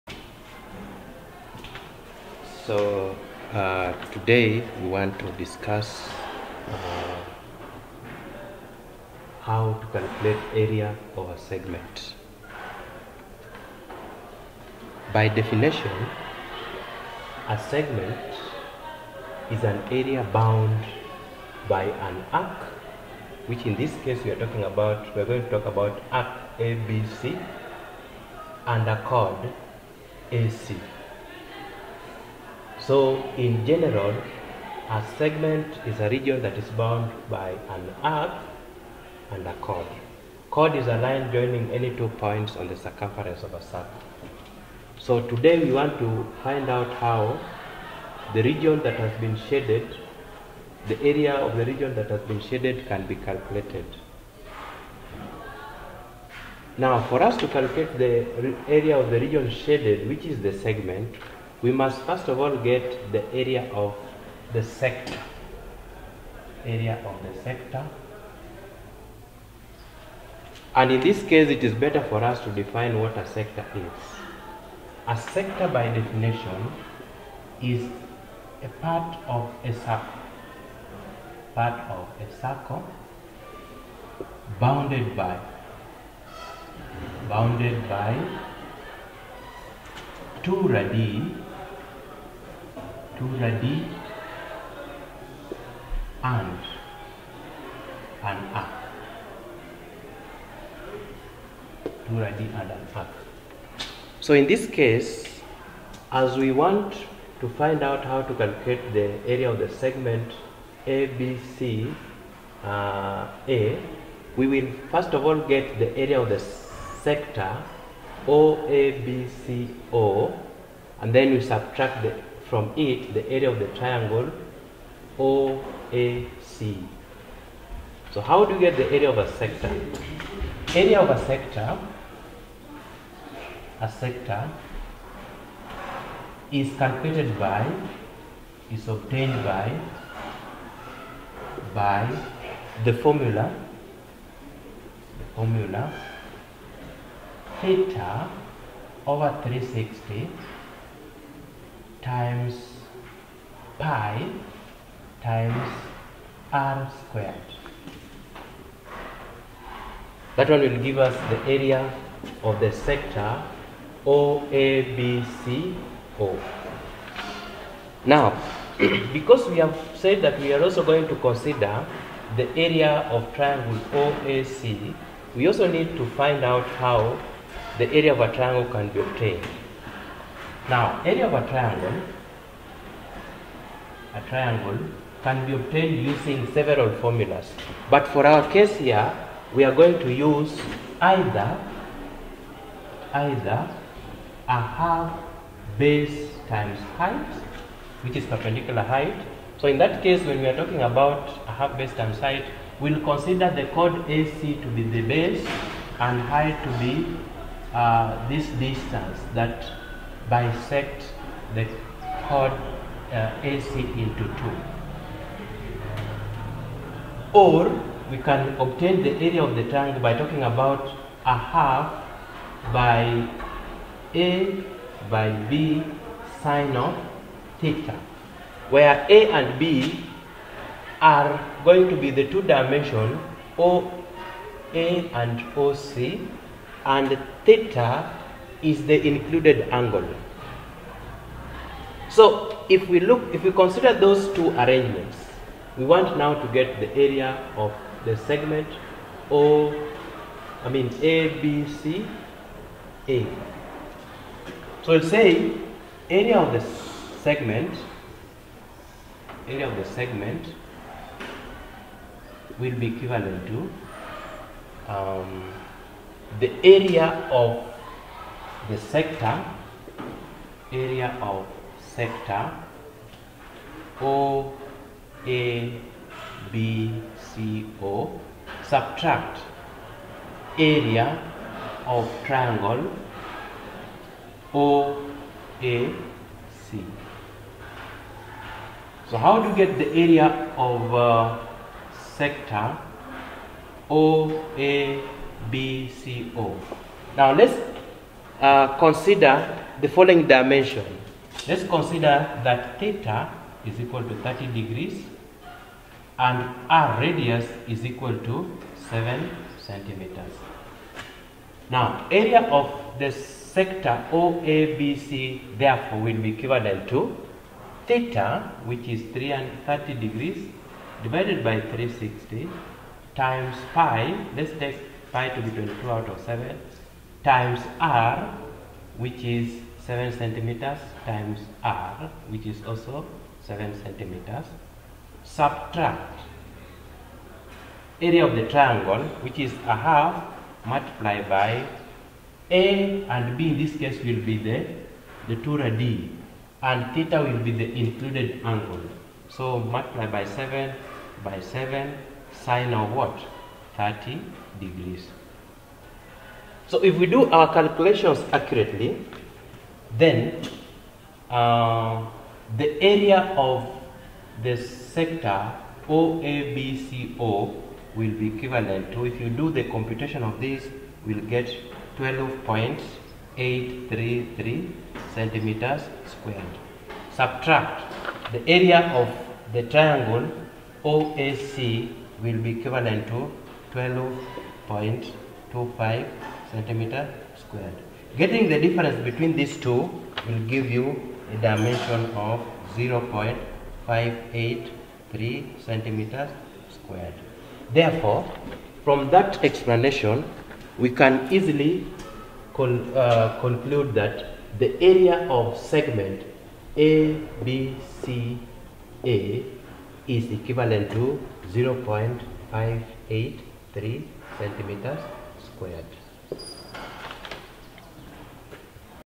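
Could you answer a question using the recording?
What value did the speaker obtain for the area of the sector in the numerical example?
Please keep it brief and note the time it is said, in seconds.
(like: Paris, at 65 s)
12.833 square centimeters, at 371 s.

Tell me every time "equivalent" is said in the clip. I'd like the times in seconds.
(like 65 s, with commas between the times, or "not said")
262 s, 316 s, 368 s, 382 s, 410 s.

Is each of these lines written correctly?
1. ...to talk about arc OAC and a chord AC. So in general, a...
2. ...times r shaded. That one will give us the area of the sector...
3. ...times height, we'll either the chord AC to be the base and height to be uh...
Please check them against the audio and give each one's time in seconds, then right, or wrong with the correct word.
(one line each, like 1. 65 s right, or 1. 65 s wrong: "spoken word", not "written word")
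1. 25 s wrong: "ABC", not "OAC"
2. 155 s wrong: "squared", not "shaded"
3. 201 s wrong: "consider", not "either".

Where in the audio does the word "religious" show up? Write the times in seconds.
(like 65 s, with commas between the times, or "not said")
not said.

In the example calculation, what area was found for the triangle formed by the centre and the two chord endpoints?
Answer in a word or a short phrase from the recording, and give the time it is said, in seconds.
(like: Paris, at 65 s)
12.25 square centimeters, at 383 s.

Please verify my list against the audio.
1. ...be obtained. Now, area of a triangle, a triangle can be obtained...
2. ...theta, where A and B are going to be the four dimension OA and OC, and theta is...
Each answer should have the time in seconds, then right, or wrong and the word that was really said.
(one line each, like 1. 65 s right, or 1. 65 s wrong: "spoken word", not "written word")
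1. 178 s right
2. 227 s wrong: "two", not "four".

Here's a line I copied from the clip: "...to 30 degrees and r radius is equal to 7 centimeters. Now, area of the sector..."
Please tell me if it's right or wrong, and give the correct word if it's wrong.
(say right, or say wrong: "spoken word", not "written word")
right.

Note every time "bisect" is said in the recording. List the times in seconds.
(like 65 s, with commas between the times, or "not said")
210 s.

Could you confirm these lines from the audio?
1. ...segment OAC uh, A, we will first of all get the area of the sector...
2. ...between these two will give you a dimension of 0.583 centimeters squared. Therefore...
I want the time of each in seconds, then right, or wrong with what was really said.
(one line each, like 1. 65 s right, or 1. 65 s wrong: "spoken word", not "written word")
1. 109 s wrong: "ABC", not "OAC"
2. 389 s right.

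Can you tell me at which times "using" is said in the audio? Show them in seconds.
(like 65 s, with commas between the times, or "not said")
186 s.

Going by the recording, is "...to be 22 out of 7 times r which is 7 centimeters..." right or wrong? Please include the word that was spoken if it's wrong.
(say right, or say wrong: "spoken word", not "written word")
right.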